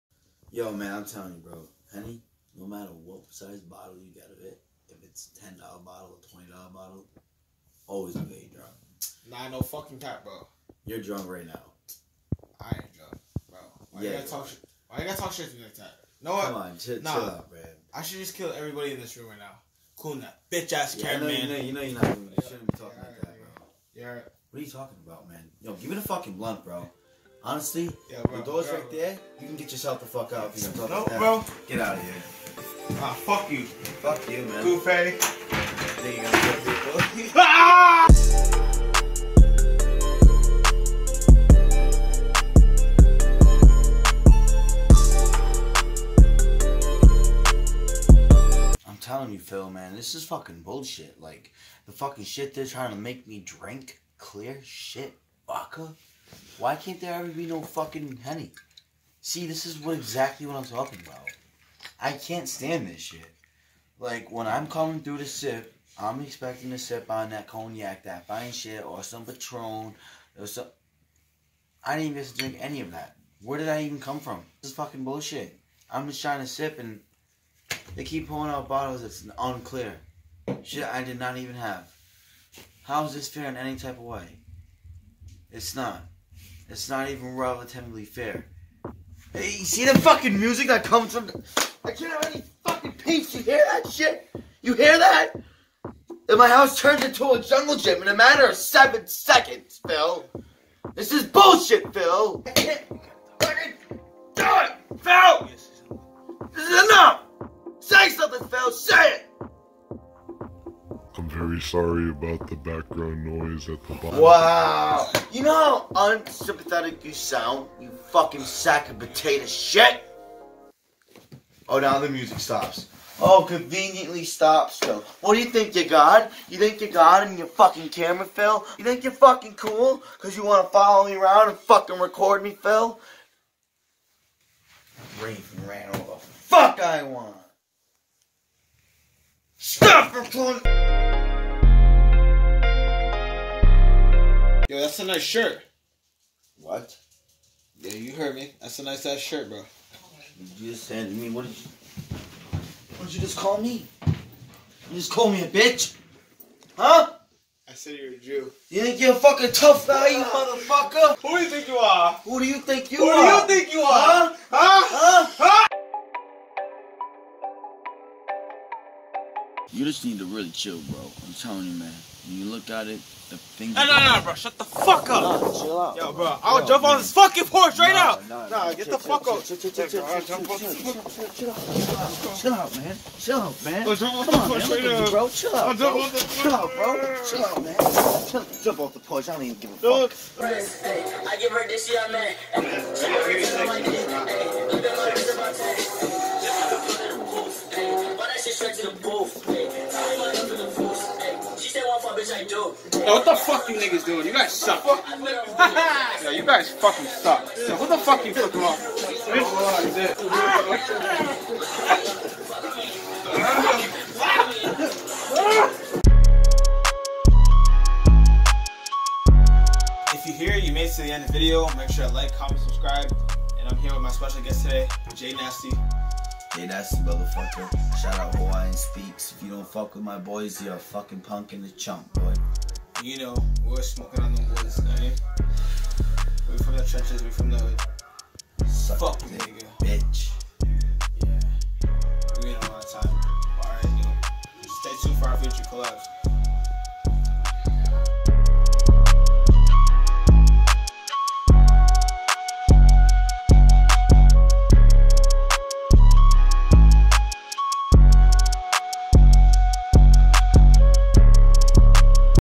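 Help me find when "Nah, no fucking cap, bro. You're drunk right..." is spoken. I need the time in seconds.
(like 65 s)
9 s.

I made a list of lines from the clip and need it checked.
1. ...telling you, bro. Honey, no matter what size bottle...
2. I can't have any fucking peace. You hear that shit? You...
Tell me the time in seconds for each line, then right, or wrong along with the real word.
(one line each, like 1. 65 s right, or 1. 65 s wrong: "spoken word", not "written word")
1. 1 s right
2. 91 s right.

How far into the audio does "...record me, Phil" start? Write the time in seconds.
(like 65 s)
131 s.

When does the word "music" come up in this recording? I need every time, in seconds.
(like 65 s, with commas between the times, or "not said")
90 s, 122 s.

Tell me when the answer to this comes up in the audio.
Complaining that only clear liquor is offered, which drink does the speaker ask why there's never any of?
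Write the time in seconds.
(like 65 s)
58 s.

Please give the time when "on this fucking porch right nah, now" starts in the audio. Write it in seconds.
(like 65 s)
176 s.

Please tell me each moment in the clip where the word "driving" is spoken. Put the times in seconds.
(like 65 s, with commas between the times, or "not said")
not said.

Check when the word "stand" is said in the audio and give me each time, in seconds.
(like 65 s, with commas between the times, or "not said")
62 s.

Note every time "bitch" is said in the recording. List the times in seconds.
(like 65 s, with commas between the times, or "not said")
20 s, 155 s.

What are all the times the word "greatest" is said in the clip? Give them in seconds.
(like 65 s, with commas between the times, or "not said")
not said.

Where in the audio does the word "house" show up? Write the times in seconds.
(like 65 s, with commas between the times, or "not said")
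96 s.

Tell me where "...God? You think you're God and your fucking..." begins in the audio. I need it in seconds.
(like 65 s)
125 s.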